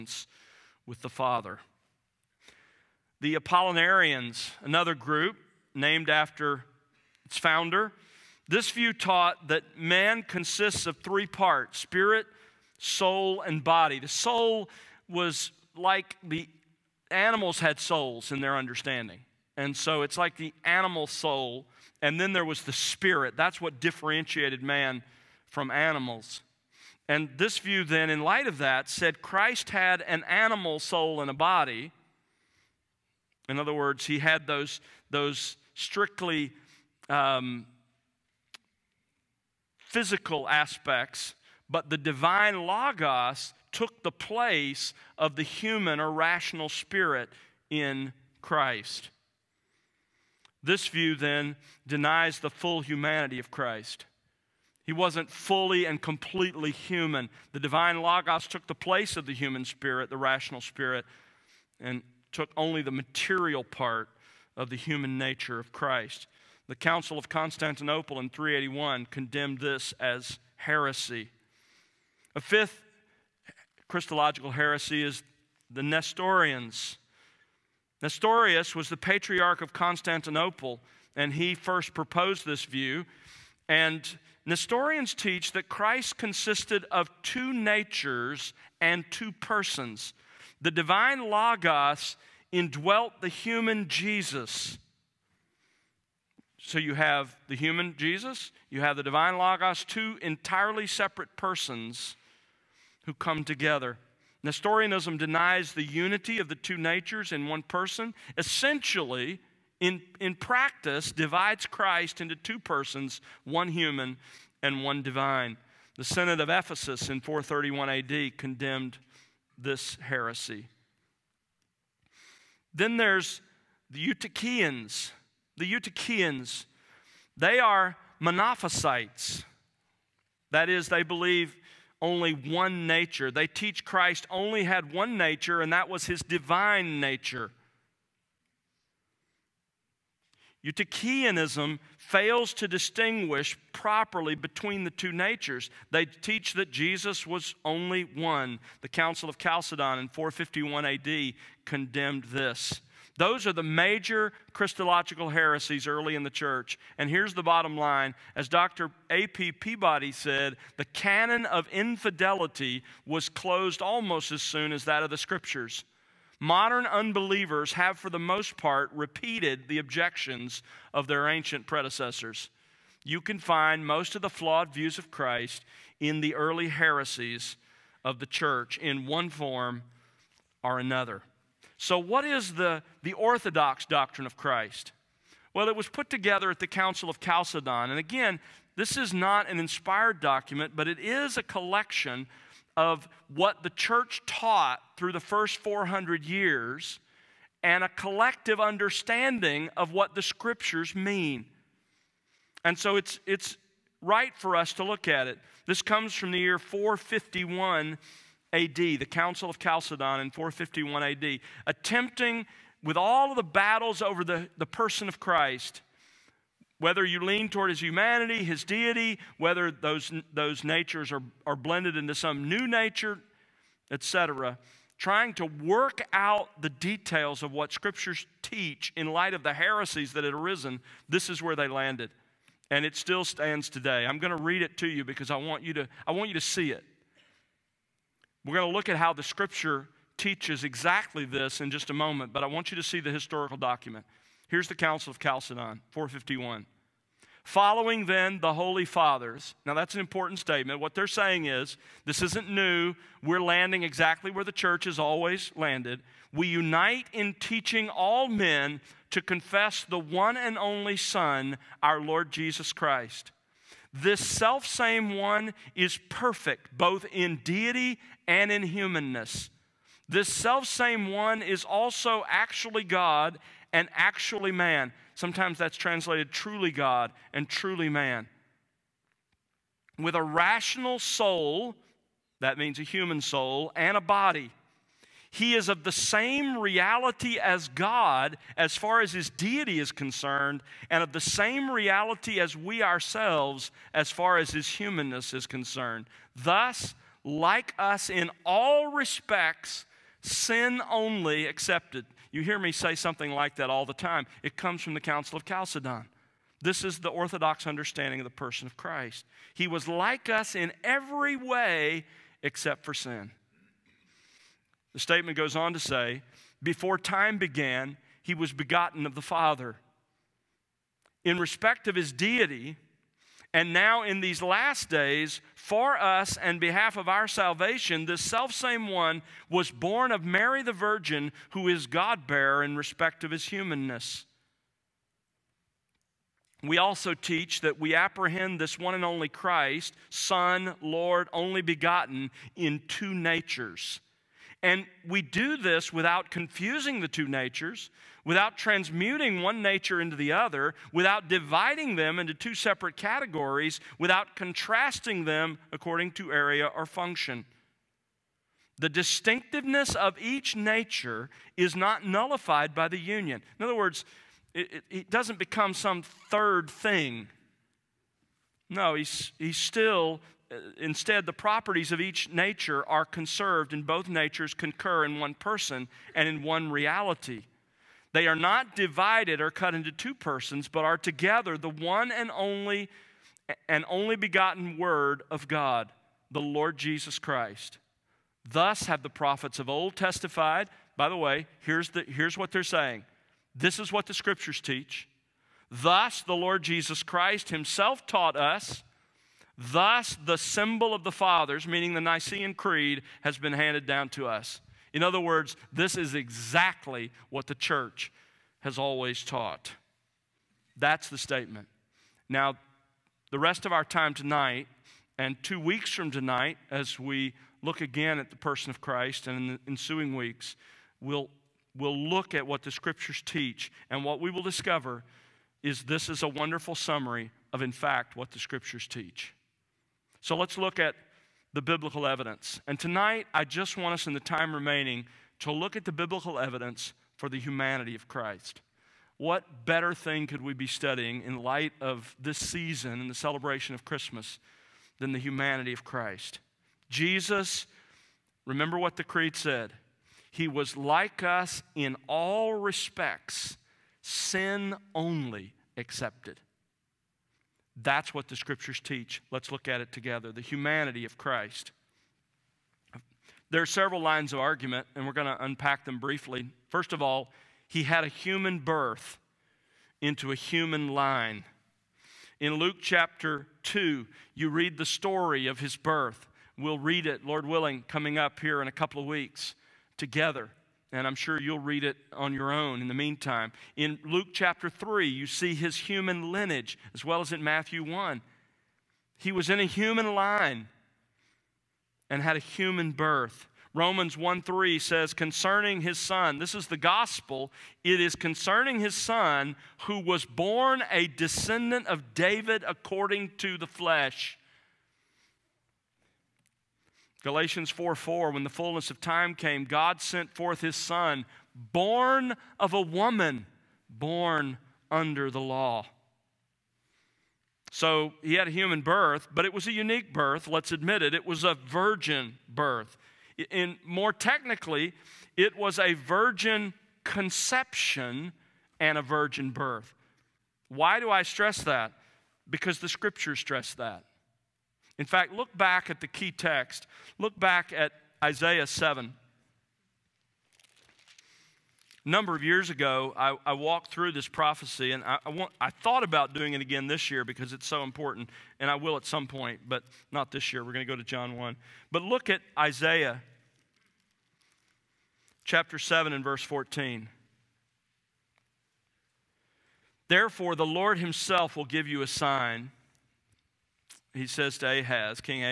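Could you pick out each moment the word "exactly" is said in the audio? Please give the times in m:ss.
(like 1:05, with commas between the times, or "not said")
4:00, 4:13, 6:46.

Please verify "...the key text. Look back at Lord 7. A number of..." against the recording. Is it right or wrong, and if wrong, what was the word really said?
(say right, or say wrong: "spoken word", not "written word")
wrong: "Isaiah", not "Lord".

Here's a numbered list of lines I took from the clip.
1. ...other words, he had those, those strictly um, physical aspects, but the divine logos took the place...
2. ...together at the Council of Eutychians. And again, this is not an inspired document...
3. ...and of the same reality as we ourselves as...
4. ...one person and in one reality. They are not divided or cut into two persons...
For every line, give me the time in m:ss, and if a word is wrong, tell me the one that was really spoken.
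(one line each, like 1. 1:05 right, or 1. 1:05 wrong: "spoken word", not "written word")
1. 0:33 right
2. 3:06 wrong: "Chalcedon", not "Eutychians"
3. 4:50 right
4. 6:15 right.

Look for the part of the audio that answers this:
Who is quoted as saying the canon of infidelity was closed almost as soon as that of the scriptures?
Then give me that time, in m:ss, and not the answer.
2:38.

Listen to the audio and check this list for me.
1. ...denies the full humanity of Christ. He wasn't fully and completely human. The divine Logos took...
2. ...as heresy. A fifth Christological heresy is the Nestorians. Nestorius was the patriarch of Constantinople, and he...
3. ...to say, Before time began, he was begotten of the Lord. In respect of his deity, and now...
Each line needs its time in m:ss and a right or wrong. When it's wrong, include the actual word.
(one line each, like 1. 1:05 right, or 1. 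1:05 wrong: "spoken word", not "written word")
1. 0:51 right
2. 1:09 right
3. 5:15 wrong: "Father", not "Lord".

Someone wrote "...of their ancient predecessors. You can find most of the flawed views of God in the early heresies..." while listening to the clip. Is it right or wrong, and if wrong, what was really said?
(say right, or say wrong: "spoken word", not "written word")
wrong: "Christ", not "God".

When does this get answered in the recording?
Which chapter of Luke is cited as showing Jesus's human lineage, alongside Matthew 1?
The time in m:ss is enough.
8:04.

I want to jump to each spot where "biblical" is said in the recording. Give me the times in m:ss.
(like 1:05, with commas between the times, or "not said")
7:11, 7:15.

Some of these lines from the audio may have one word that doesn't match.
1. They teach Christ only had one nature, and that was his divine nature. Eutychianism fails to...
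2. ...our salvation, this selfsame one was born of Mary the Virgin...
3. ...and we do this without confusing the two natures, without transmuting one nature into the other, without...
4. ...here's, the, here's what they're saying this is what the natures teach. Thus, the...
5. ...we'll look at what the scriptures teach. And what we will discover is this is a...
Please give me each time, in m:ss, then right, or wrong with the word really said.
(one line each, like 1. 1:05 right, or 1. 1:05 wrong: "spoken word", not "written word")
1. 2:13 right
2. 5:27 right
3. 5:44 right
4. 6:31 wrong: "scriptures", not "natures"
5. 7:01 right.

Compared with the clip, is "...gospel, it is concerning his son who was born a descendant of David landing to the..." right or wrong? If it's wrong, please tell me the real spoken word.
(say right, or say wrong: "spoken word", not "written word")
wrong: "according", not "landing".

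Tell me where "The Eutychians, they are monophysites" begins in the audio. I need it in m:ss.
2:05.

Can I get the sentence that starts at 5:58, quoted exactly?
The distinctiveness of each nature is not nullified by the union.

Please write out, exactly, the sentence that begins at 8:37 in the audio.
So he had a human birth, but it was a unique birth, let's admit it.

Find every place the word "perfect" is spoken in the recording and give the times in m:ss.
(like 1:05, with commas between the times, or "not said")
4:26.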